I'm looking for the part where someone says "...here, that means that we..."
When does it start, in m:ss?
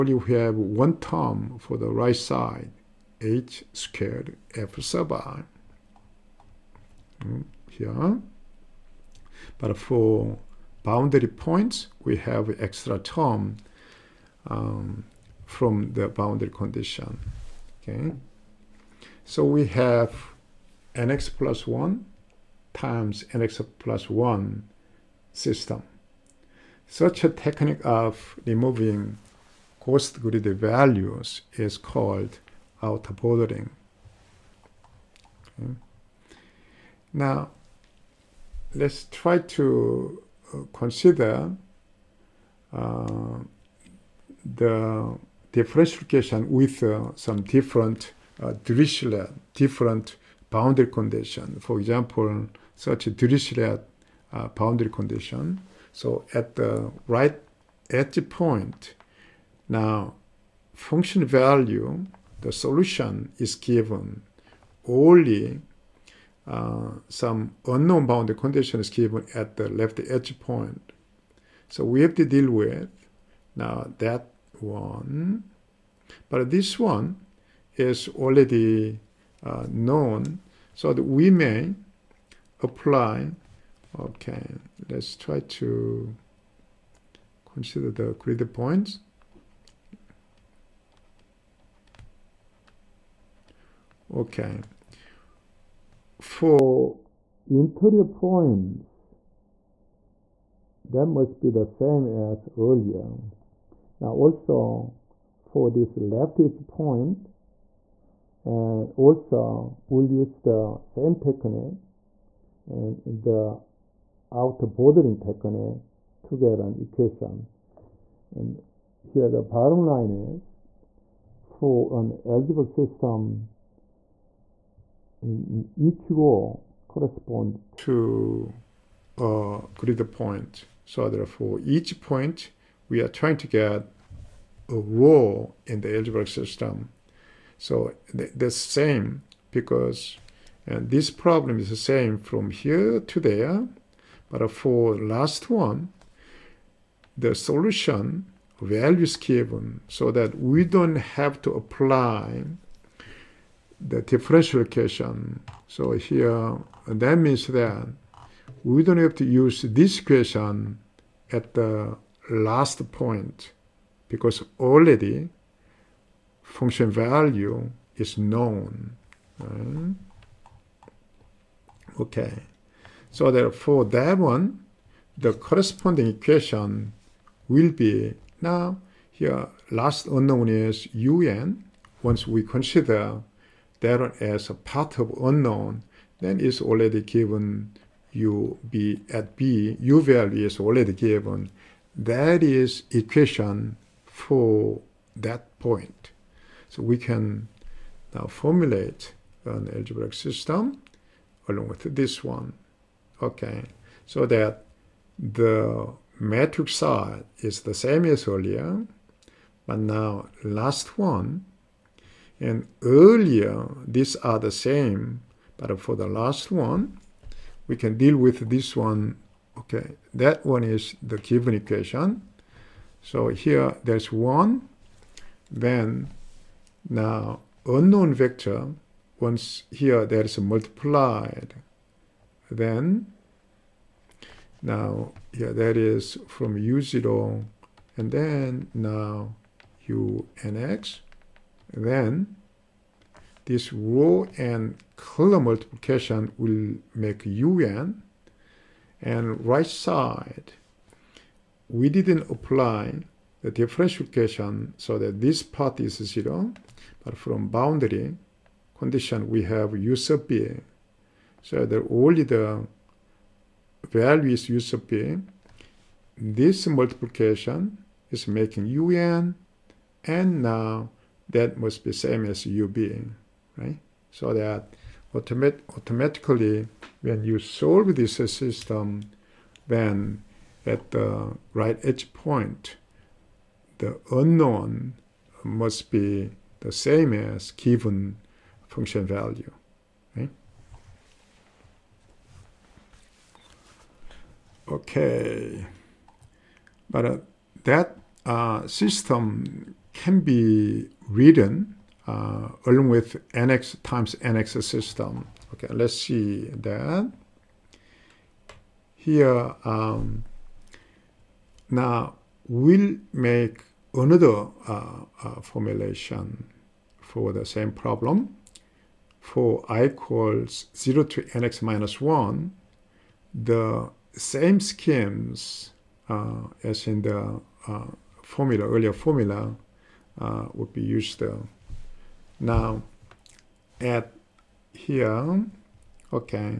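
2:35.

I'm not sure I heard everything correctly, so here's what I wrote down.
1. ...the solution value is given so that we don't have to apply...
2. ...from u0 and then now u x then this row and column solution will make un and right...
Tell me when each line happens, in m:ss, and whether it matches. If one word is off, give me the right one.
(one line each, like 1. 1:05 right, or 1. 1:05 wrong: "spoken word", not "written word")
1. 2:27 right
2. 3:56 wrong: "multiplication", not "solution".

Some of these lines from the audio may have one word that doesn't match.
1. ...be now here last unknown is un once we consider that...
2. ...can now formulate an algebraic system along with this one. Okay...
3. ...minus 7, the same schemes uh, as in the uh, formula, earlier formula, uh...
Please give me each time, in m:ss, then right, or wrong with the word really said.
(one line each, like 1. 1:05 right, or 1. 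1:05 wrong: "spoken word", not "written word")
1. 2:57 right
2. 3:16 right
3. 5:21 wrong: "1", not "7".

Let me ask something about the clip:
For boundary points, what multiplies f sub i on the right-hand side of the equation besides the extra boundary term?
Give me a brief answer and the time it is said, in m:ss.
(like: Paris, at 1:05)
h squared, at 0:03.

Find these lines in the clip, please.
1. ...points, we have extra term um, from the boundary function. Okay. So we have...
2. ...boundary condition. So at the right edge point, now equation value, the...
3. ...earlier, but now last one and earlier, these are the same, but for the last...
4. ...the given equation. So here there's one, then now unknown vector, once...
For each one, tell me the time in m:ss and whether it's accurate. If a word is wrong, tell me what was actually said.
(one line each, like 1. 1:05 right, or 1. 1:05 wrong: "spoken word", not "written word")
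1. 0:11 wrong: "condition", not "function"
2. 0:54 wrong: "function", not "equation"
3. 3:28 right
4. 3:41 right.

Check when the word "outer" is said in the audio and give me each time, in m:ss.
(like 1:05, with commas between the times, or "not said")
0:32, 1:54.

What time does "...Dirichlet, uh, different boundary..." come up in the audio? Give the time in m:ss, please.
0:48.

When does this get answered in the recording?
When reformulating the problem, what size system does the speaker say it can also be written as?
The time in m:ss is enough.
5:03.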